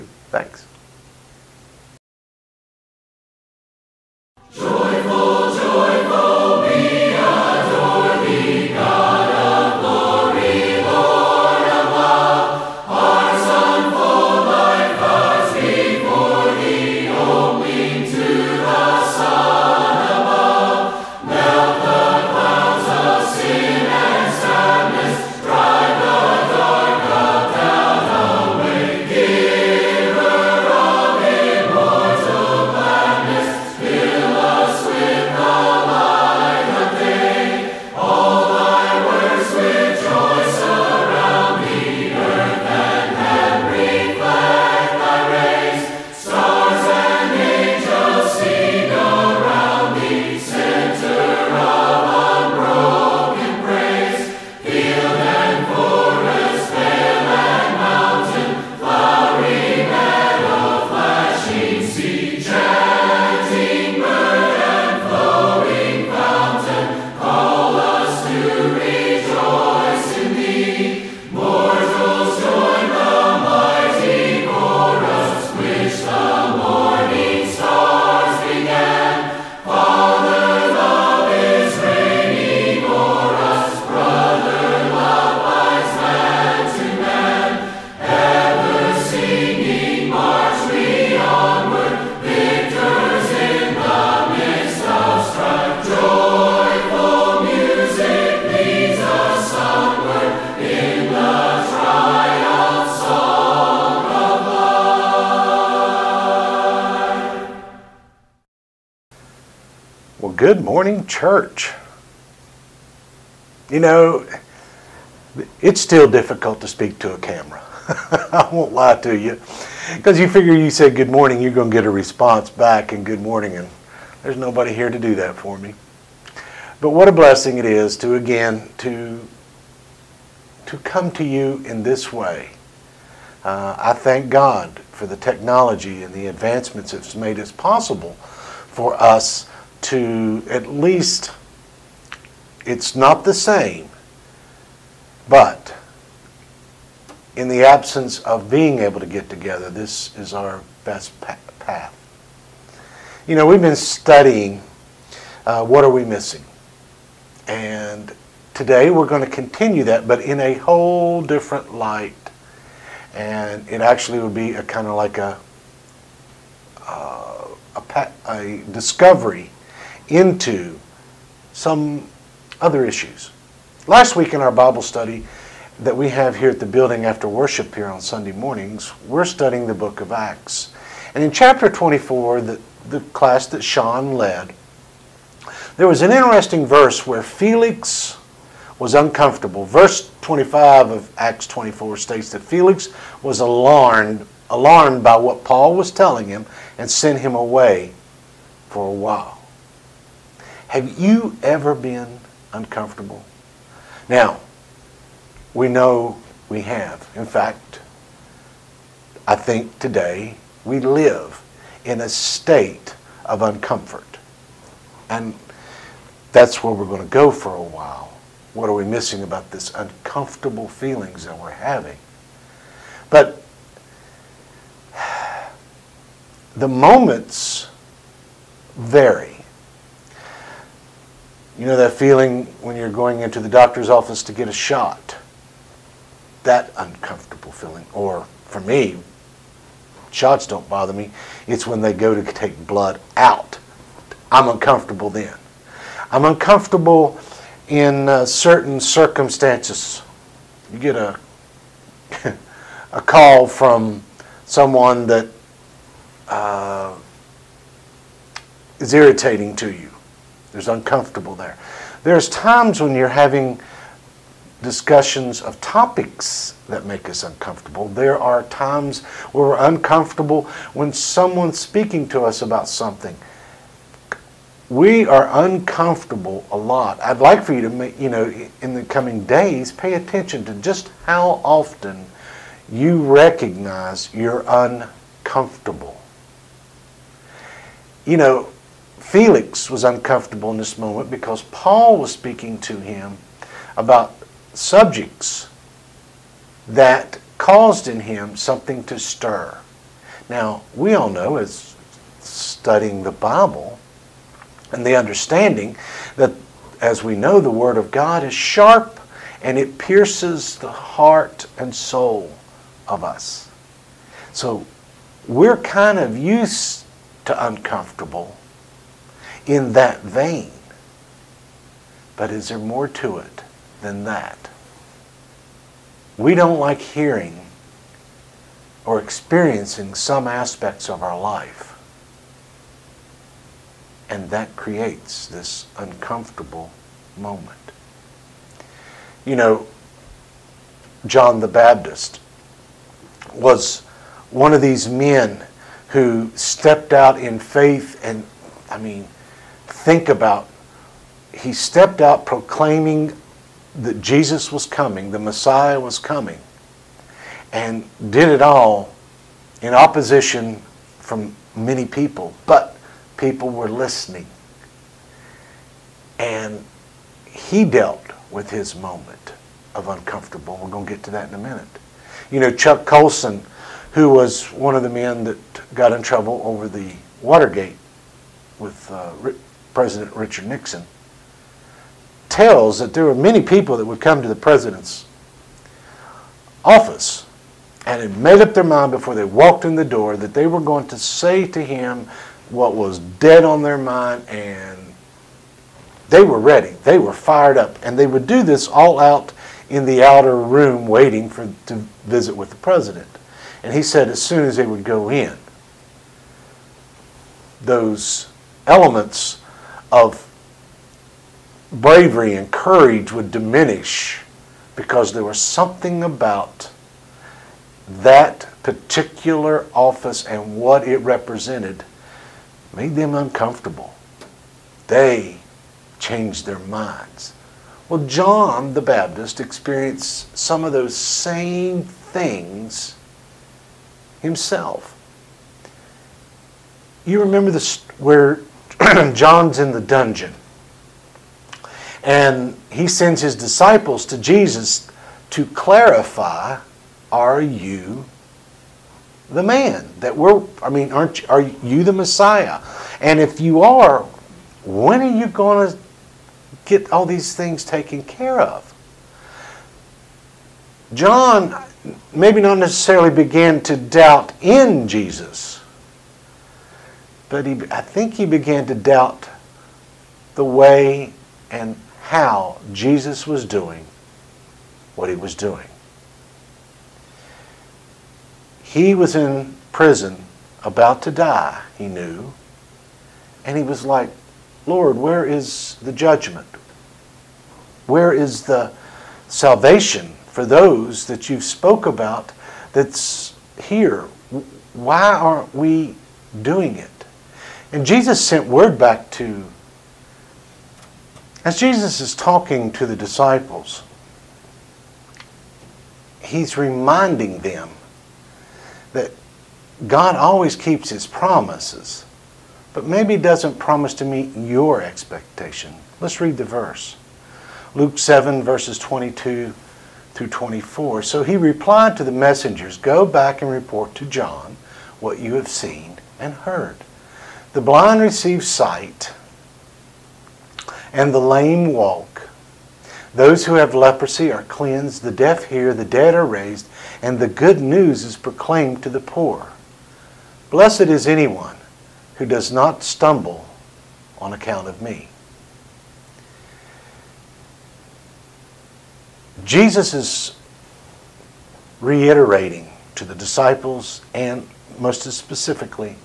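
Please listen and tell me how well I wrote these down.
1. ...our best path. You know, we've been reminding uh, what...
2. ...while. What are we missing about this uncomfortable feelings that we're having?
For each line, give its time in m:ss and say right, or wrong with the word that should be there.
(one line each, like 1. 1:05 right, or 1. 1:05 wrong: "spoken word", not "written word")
1. 2:30 wrong: "studying", not "reminding"
2. 3:37 right.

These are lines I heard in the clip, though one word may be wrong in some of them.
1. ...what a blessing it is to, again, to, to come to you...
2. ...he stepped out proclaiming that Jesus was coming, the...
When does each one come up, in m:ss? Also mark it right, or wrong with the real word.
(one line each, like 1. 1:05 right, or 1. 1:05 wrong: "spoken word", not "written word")
1. 2:06 right
2. 5:51 right.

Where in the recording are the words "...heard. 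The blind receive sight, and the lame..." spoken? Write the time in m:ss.
8:46.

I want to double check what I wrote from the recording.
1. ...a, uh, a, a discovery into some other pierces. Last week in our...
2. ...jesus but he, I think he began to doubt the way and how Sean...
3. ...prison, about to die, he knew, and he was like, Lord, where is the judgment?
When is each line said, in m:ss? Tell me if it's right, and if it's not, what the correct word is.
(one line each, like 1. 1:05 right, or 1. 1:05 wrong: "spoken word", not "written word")
1. 2:45 wrong: "issues", not "pierces"
2. 7:44 wrong: "Jesus", not "Sean"
3. 7:59 right.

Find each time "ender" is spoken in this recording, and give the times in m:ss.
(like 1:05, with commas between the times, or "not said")
not said.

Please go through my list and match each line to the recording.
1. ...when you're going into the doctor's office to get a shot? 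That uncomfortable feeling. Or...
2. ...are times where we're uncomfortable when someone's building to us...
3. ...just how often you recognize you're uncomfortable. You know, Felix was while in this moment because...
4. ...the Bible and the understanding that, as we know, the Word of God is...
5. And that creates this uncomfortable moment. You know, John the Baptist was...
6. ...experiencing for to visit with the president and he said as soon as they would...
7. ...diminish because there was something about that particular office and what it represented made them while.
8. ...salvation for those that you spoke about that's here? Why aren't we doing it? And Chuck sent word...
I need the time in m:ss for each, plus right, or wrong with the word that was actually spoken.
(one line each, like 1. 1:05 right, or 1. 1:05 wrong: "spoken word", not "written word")
1. 3:52 right
2. 4:28 wrong: "speaking", not "building"
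3. 4:40 wrong: "uncomfortable", not "while"
4. 5:03 right
5. 5:34 right
6. 6:40 wrong: "waiting", not "experiencing"
7. 6:53 wrong: "uncomfortable", not "while"
8. 8:09 wrong: "Jesus", not "Chuck".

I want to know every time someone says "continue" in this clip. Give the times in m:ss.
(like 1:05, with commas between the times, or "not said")
2:39.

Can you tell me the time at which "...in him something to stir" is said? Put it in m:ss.
4:57.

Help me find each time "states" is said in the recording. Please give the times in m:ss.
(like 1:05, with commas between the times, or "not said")
3:11, 3:32.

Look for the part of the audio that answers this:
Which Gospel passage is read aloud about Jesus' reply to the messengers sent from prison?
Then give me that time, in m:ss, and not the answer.
8:37.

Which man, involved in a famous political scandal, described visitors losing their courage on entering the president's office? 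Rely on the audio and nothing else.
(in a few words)
Chuck Colson.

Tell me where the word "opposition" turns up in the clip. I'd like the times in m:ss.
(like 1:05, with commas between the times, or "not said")
5:59.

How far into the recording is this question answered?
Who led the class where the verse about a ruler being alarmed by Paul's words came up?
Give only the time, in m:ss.
3:03.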